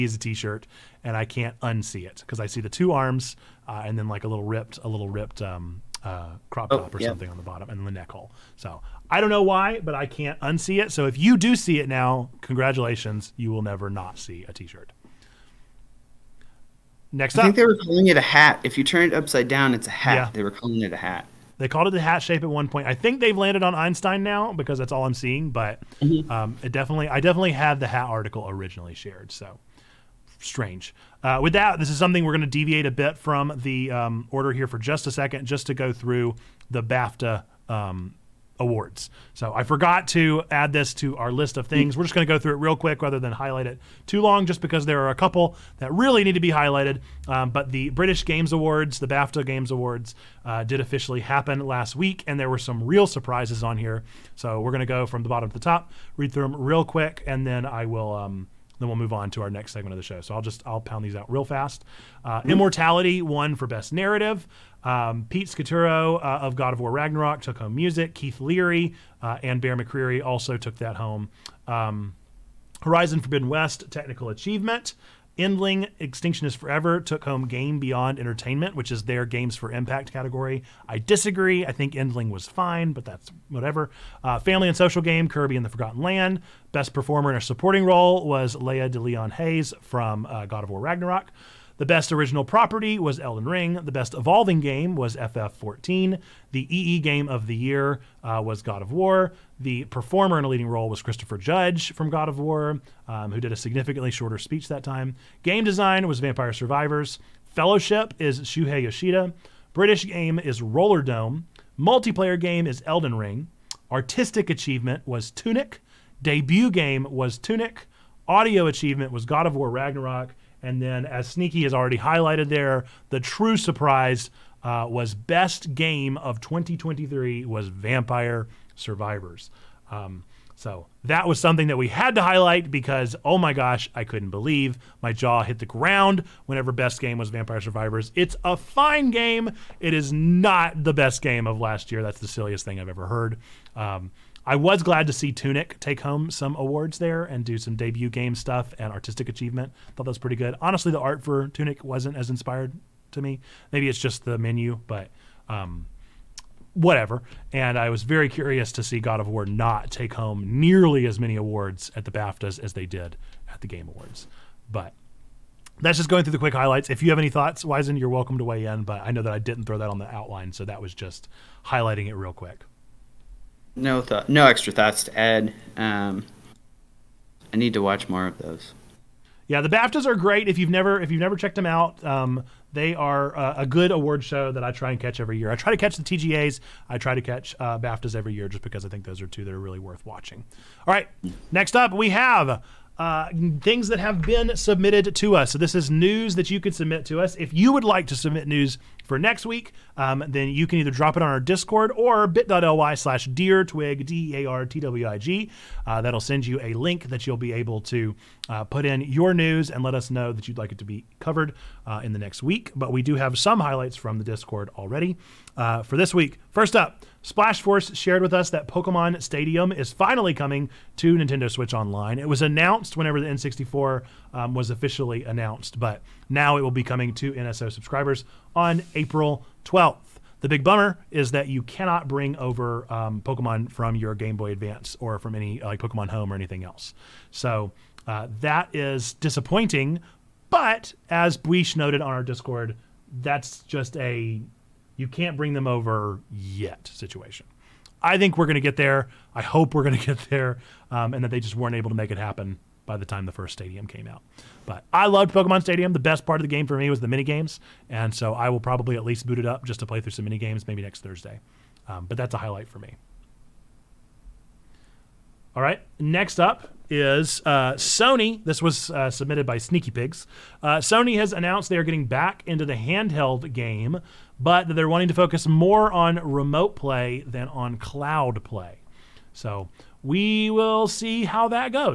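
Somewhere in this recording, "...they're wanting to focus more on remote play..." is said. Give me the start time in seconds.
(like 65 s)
274 s.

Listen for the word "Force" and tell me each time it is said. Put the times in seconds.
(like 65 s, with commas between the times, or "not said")
217 s.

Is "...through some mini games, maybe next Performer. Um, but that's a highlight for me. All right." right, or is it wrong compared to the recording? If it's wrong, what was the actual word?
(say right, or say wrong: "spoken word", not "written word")
wrong: "Thursday", not "Performer".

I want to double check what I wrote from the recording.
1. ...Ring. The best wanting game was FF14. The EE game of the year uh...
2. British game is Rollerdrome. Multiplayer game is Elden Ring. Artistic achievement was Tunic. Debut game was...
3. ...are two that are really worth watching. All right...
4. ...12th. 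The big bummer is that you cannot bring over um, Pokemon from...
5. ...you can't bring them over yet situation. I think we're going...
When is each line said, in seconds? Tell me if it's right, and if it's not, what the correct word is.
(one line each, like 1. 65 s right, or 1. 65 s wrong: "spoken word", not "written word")
1. 93 s wrong: "evolving", not "wanting"
2. 109 s right
3. 189 s right
4. 229 s right
5. 244 s right.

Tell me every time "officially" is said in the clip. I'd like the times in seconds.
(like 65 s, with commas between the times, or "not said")
50 s, 224 s.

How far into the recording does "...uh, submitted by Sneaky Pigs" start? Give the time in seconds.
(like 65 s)
268 s.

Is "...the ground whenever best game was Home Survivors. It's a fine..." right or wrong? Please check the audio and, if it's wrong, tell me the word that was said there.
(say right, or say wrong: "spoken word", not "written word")
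wrong: "Vampire", not "Home".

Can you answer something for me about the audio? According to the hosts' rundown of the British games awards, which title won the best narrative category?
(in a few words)
Immortality.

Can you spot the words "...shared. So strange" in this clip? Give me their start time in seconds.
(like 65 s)
28 s.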